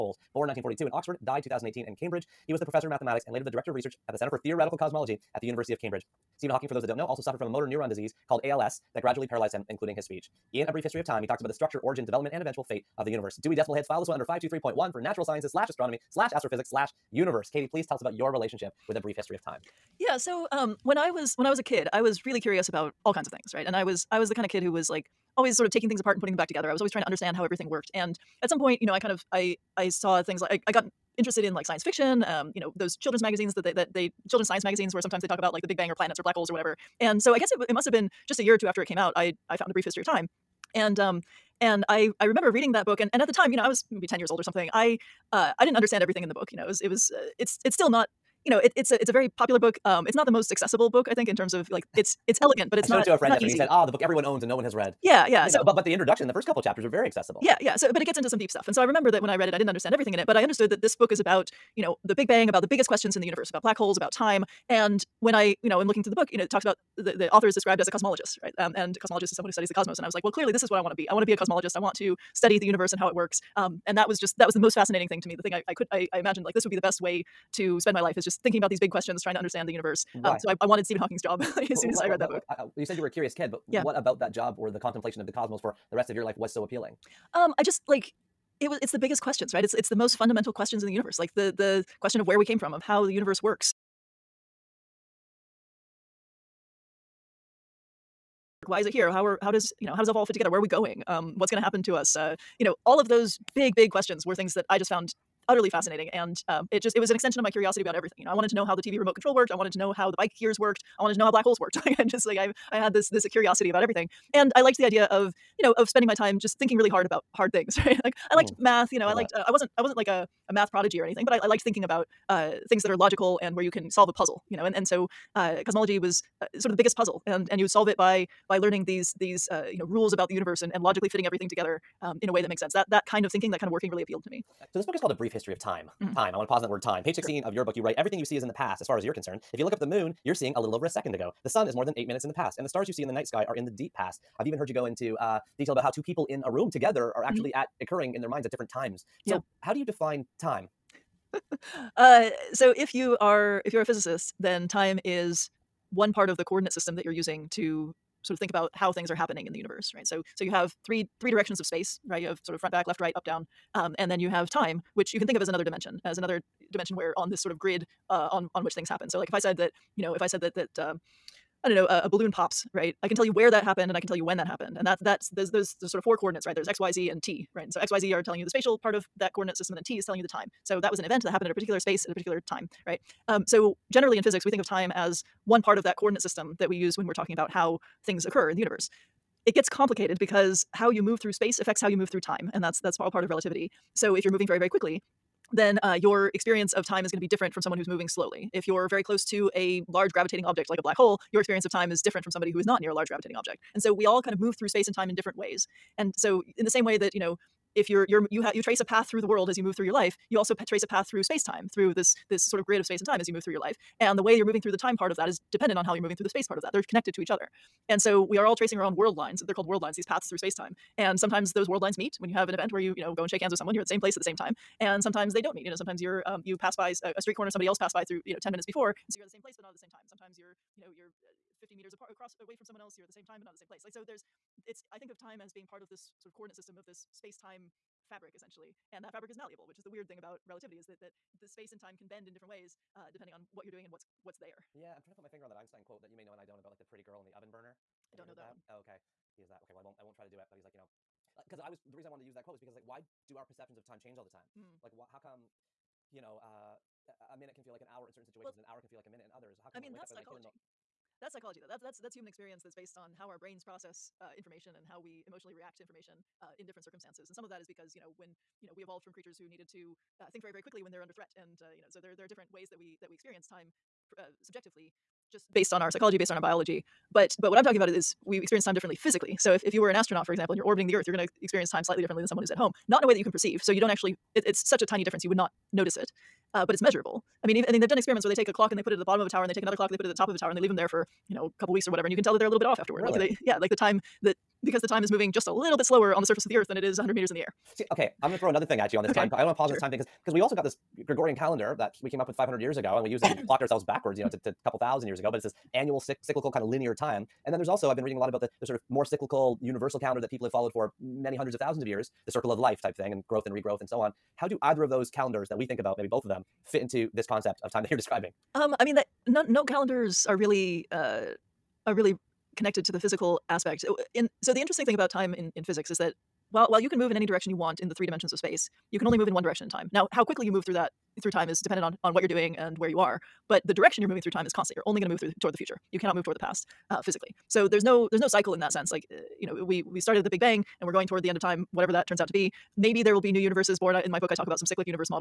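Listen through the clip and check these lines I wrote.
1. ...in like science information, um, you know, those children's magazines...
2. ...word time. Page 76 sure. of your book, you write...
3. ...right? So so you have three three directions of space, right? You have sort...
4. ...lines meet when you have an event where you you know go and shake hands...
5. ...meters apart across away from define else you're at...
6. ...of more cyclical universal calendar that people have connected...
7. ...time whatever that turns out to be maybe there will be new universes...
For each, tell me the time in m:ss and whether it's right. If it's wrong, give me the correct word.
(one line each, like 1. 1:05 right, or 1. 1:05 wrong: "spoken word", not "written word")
1. 0:31 wrong: "fiction", not "information"
2. 2:16 wrong: "16", not "76"
3. 2:39 right
4. 3:41 right
5. 3:51 wrong: "someone", not "define"
6. 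5:08 wrong: "followed", not "connected"
7. 5:41 right.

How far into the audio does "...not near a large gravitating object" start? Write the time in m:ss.
3:22.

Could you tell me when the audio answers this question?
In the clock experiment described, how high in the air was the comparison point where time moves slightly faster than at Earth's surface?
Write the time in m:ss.
4:56.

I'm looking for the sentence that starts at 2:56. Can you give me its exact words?
There's x, y, z, and t, right?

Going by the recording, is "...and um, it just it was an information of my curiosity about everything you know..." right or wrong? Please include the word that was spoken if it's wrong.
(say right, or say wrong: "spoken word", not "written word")
wrong: "extension", not "information".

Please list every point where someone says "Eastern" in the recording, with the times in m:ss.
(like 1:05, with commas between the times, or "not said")
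not said.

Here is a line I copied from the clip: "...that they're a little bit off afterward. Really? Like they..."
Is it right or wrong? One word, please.
right.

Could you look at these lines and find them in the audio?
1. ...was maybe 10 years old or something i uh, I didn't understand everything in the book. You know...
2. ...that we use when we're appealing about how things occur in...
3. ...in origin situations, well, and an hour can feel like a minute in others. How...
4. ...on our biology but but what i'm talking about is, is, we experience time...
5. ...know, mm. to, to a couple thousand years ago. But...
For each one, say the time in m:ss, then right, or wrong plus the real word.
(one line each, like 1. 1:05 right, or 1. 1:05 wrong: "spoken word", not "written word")
1. 0:43 right
2. 3:06 wrong: "talking", not "appealing"
3. 4:18 wrong: "certain", not "origin"
4. 4:36 right
5. 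5:04 right.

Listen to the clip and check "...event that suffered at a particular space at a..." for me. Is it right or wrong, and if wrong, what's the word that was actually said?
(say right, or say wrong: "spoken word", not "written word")
wrong: "happened", not "suffered".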